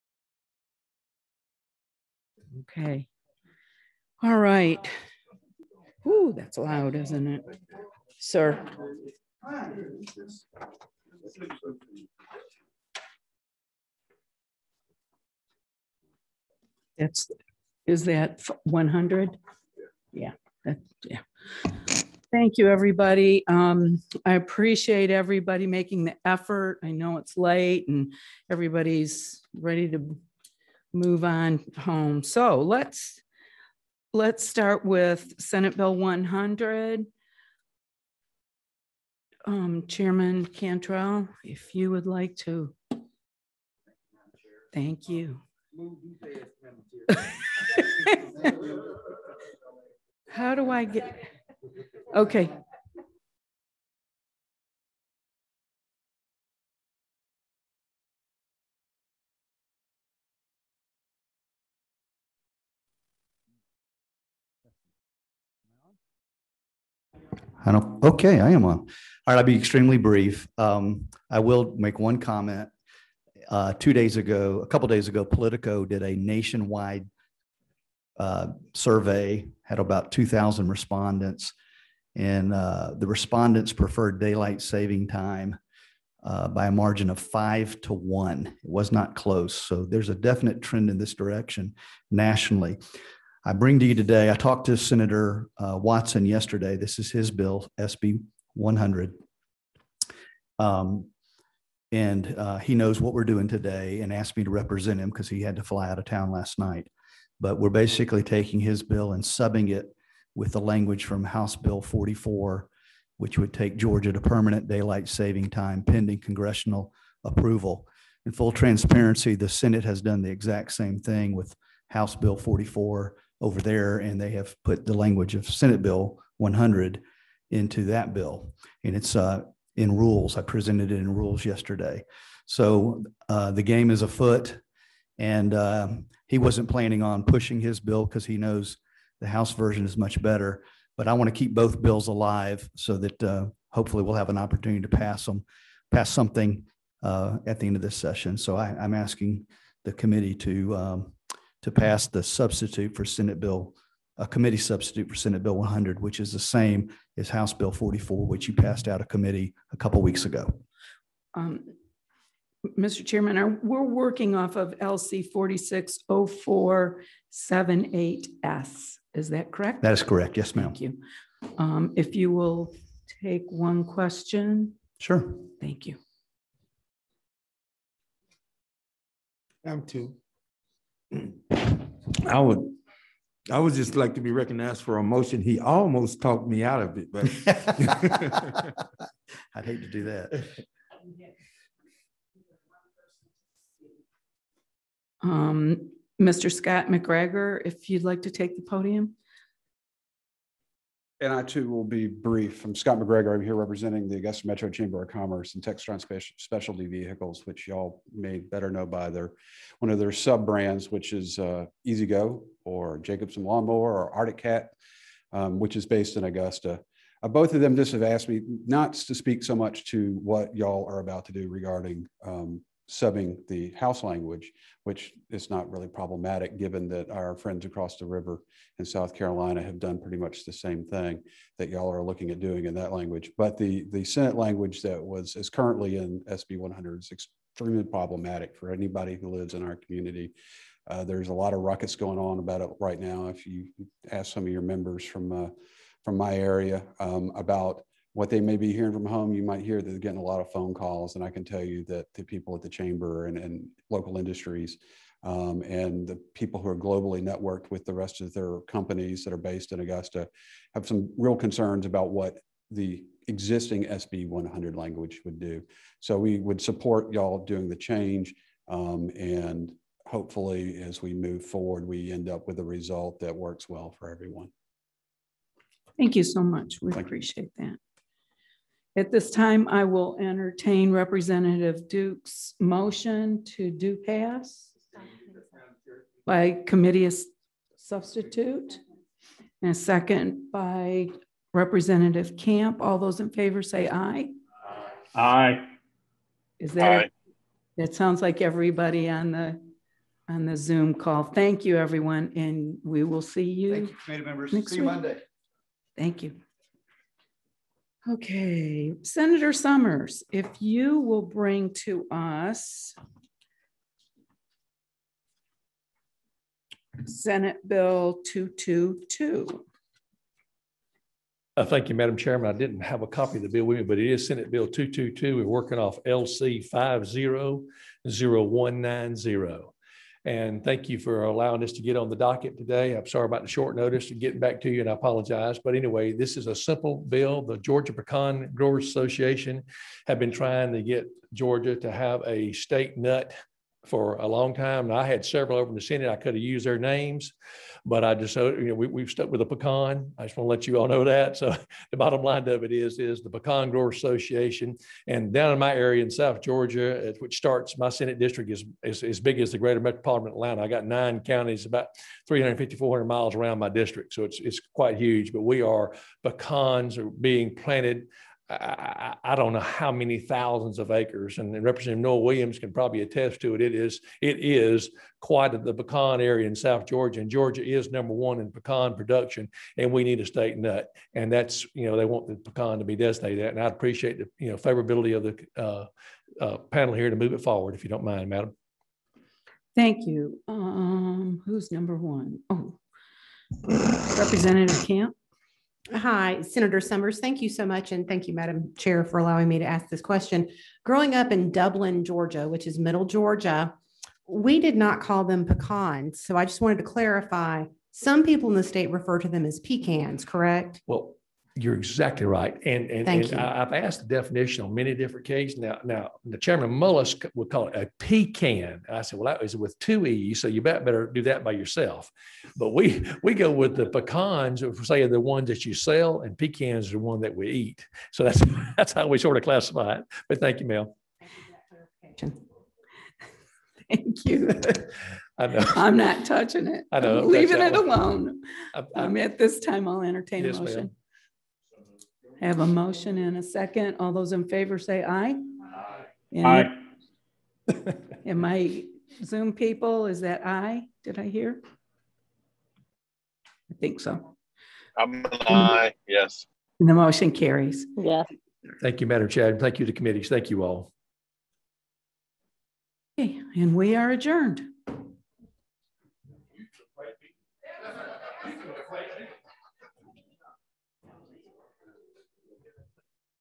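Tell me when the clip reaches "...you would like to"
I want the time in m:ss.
0:41.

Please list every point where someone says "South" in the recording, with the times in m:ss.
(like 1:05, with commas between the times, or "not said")
3:48, 5:56, 6:16.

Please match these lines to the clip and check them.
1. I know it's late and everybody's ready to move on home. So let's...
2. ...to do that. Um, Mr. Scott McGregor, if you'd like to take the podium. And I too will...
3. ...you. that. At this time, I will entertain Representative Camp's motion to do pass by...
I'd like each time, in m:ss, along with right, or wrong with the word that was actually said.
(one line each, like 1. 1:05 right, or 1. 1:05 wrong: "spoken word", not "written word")
1. 0:26 right
2. 3:09 right
3. 4:37 wrong: "Duke", not "Camp".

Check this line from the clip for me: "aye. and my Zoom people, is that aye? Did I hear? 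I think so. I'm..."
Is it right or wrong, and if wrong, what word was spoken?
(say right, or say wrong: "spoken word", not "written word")
right.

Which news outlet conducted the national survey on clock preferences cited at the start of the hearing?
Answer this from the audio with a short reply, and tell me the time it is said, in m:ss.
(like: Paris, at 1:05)
Politico, at 1:15.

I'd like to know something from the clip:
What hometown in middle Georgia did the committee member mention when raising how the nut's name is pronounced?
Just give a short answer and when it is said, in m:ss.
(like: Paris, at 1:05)
Dublin, at 6:41.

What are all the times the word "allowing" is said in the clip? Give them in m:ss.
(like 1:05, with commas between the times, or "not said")
5:31, 6:39.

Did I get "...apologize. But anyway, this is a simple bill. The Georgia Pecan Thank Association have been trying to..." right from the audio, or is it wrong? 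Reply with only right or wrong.
wrong.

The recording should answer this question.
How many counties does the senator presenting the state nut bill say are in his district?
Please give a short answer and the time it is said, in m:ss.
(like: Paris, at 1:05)
9, at 6:00.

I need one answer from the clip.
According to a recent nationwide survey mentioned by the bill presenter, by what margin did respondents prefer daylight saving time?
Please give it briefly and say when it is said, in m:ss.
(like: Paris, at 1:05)
5 to 1, at 1:27.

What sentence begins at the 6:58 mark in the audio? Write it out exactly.
I said, well, that is with two E's, so you better do that by yourself.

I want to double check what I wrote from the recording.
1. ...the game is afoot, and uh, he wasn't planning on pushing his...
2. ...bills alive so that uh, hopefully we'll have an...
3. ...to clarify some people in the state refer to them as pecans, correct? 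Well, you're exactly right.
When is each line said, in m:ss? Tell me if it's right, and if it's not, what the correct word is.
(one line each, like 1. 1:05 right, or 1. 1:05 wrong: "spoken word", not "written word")
1. 2:13 right
2. 2:21 right
3. 6:46 right.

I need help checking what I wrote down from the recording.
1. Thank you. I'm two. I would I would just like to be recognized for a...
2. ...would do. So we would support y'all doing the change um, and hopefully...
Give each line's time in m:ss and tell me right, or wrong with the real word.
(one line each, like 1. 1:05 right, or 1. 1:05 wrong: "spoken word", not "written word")
1. 2:55 right
2. 4:25 right.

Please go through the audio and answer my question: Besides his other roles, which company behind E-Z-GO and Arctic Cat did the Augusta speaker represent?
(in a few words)
Textron Specialty Vehicles.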